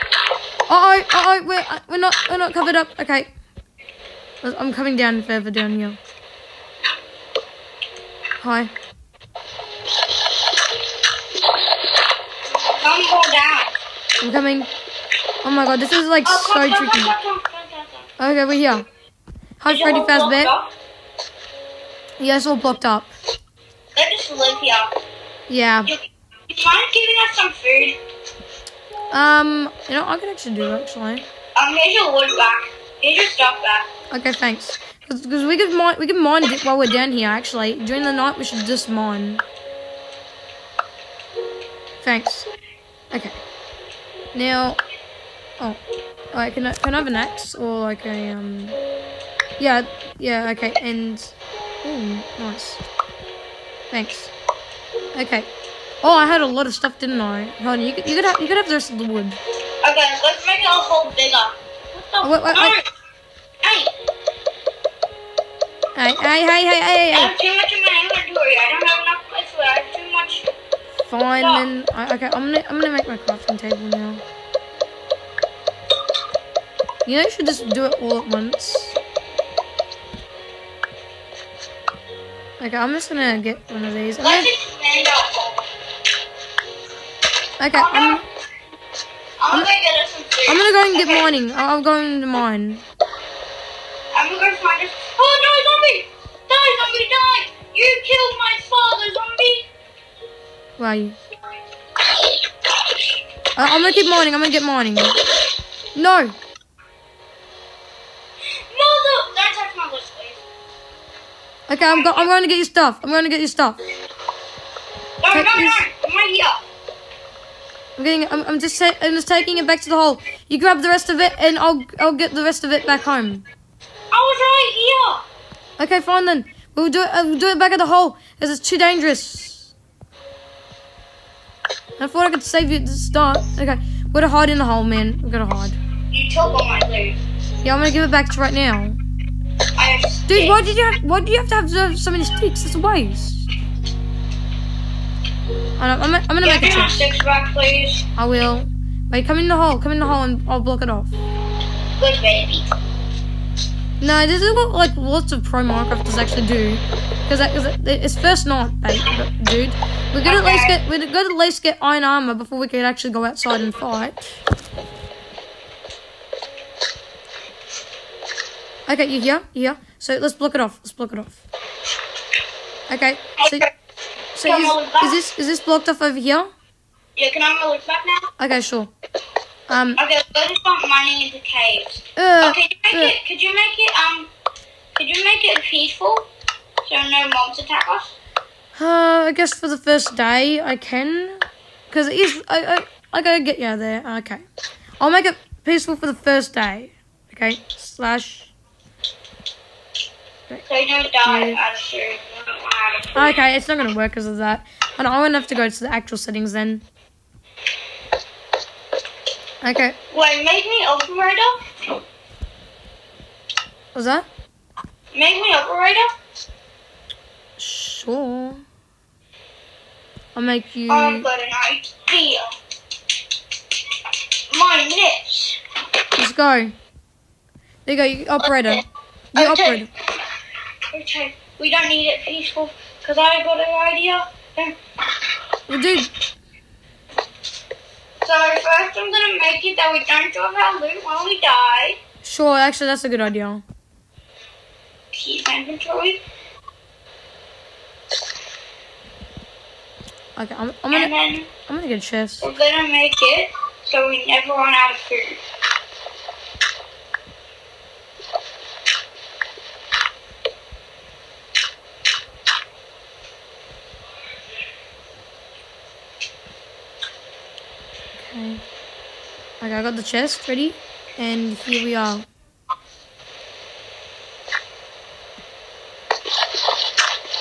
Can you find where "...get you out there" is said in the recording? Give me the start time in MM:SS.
03:13.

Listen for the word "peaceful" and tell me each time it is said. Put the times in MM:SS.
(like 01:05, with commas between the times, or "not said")
03:05, 03:15, 03:52.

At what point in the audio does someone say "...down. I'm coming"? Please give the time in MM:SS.
00:13.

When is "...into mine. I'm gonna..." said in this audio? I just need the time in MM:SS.
01:31.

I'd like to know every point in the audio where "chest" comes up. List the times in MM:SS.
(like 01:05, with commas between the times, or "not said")
02:26, 04:12, 04:30.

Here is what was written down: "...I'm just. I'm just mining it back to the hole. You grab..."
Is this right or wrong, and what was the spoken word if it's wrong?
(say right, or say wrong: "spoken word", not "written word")
wrong: "taking", not "mining".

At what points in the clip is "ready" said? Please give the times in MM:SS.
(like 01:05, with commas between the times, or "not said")
04:30.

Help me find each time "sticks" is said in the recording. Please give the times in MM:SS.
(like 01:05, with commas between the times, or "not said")
02:22, 02:26.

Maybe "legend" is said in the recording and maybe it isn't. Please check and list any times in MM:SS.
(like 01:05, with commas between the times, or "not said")
not said.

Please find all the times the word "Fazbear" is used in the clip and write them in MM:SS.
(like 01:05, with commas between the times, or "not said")
00:19.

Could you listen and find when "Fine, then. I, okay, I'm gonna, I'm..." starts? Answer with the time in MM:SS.
01:11.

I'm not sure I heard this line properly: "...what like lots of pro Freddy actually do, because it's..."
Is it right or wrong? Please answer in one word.
wrong.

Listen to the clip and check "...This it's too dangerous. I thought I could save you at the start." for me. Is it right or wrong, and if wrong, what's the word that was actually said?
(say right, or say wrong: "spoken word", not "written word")
right.